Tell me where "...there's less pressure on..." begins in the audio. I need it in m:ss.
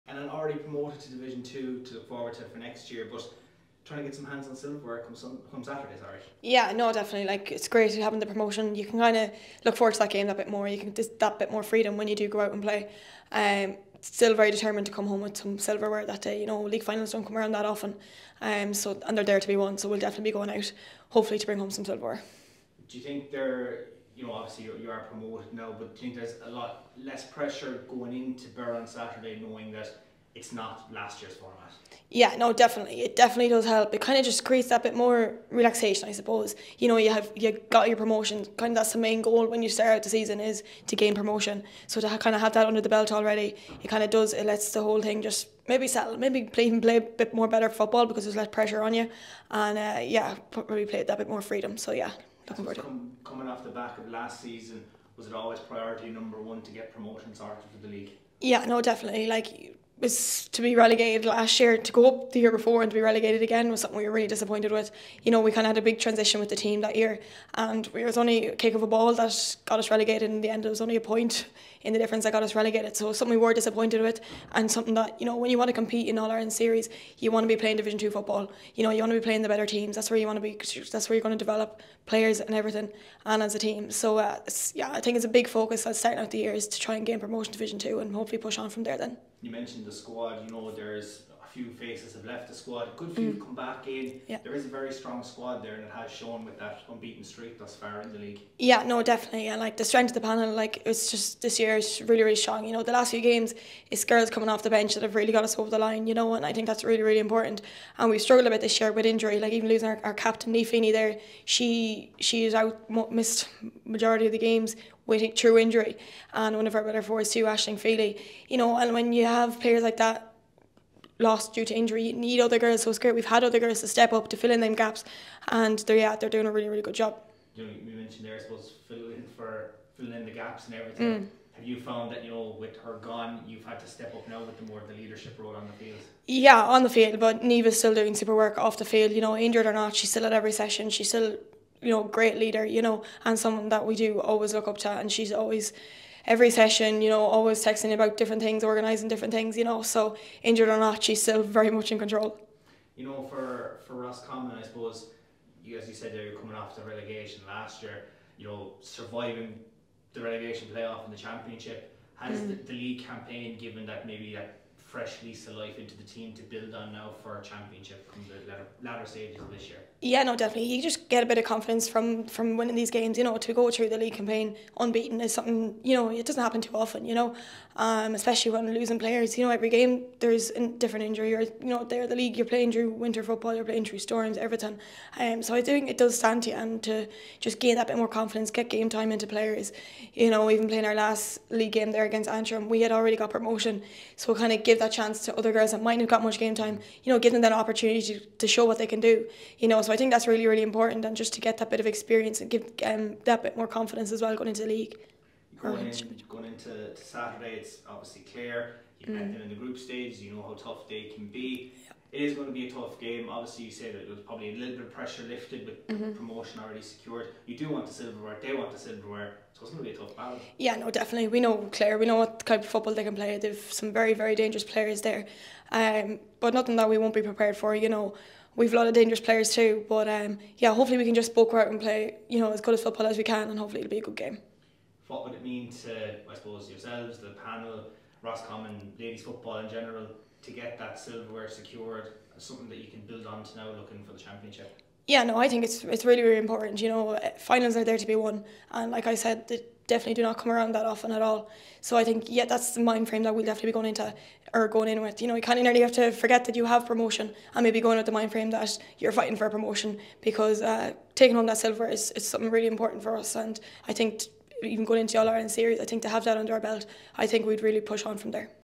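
0:48.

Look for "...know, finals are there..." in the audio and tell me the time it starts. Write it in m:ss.
4:06.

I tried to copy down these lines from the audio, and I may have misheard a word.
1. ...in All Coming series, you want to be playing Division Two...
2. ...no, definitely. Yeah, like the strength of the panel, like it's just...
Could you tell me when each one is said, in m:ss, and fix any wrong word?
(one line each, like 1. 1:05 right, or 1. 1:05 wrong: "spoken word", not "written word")
1. 1:16 wrong: "Ireland", not "Coming"
2. 1:38 right.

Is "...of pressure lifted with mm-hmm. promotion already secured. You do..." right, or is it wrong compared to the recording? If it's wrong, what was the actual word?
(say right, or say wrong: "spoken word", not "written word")
right.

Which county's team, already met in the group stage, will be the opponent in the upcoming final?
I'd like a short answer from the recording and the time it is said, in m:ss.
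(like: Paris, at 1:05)
Clare, at 3:41.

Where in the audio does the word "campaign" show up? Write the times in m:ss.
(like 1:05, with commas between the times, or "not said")
2:43, 2:54.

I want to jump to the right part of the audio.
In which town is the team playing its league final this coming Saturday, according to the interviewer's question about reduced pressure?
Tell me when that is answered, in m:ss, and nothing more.
0:28.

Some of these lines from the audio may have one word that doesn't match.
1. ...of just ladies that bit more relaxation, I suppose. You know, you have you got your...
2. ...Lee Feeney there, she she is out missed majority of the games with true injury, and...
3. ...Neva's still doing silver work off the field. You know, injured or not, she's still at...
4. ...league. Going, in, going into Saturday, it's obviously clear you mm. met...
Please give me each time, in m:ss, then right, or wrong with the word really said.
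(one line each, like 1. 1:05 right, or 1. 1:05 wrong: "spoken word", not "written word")
1. 0:34 wrong: "creates", not "ladies"
2. 1:50 right
3. 2:17 wrong: "super", not "silver"
4. 3:24 right.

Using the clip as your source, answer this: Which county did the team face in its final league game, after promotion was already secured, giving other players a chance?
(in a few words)
Antrim.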